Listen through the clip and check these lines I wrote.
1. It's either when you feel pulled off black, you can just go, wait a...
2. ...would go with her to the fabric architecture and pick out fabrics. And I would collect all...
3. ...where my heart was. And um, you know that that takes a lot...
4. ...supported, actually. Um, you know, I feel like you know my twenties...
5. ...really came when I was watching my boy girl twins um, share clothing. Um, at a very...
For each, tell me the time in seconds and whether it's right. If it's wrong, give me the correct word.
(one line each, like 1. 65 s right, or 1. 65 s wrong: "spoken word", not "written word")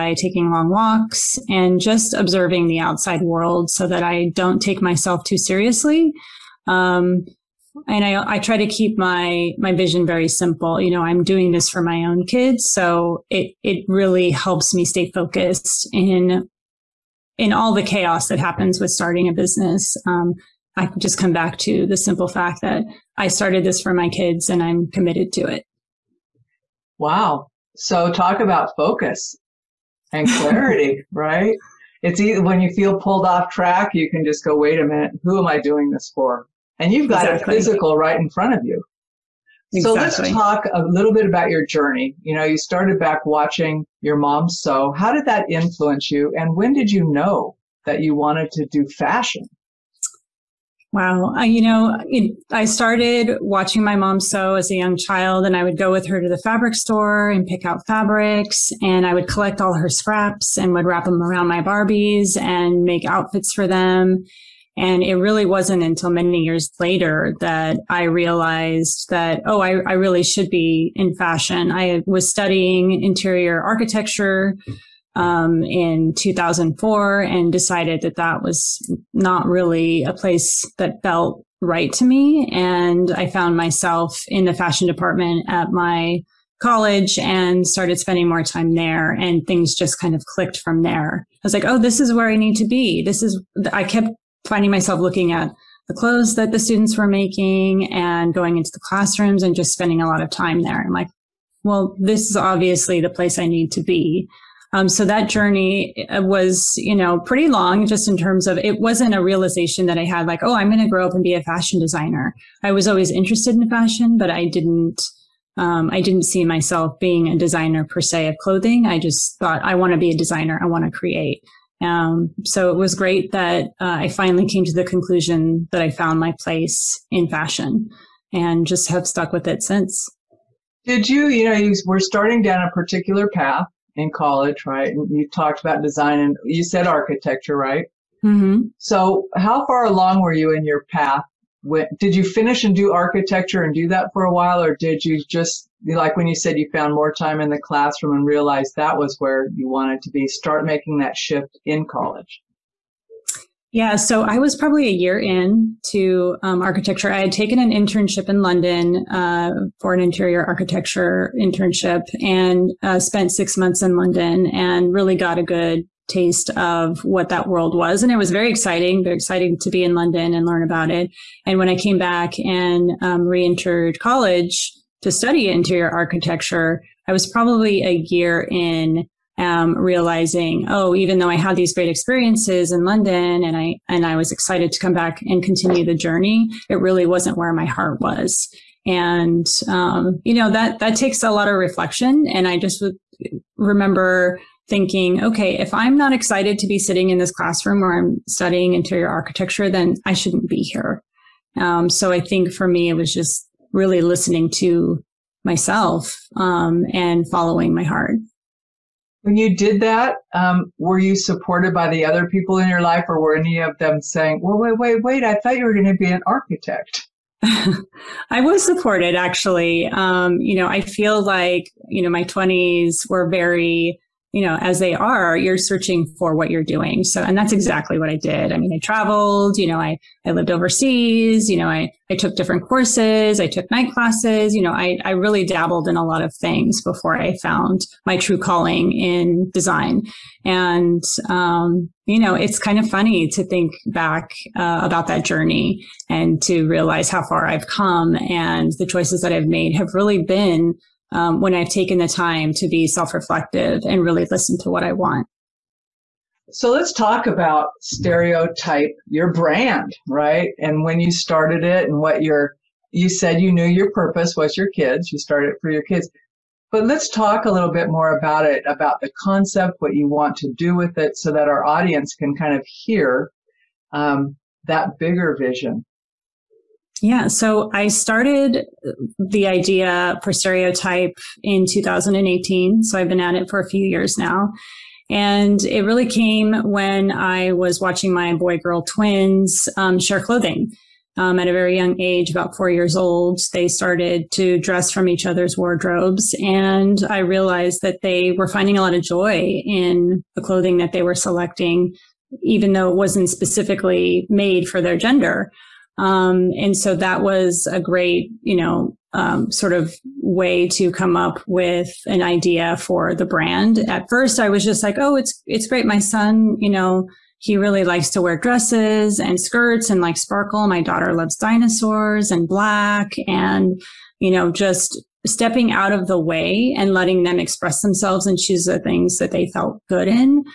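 1. 32 s wrong: "track", not "black"
2. 55 s wrong: "store", not "architecture"
3. 187 s right
4. 218 s right
5. 285 s right.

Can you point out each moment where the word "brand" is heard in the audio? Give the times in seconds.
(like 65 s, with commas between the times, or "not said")
259 s, 313 s.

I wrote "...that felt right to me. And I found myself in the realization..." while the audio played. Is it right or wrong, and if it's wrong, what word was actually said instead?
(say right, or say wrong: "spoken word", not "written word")
wrong: "fashion", not "realization".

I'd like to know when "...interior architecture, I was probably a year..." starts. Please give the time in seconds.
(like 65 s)
175 s.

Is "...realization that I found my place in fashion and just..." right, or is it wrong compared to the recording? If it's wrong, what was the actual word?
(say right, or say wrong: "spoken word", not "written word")
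wrong: "conclusion", not "realization".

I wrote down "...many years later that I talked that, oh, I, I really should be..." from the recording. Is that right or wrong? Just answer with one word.
wrong.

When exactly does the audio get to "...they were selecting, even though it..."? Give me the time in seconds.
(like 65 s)
300 s.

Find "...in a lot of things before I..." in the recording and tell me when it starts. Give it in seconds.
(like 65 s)
235 s.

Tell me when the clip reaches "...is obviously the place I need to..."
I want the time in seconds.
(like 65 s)
102 s.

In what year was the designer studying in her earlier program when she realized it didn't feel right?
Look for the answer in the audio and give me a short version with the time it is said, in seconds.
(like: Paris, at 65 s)
2004, at 76 s.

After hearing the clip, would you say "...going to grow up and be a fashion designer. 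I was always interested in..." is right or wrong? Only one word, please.
right.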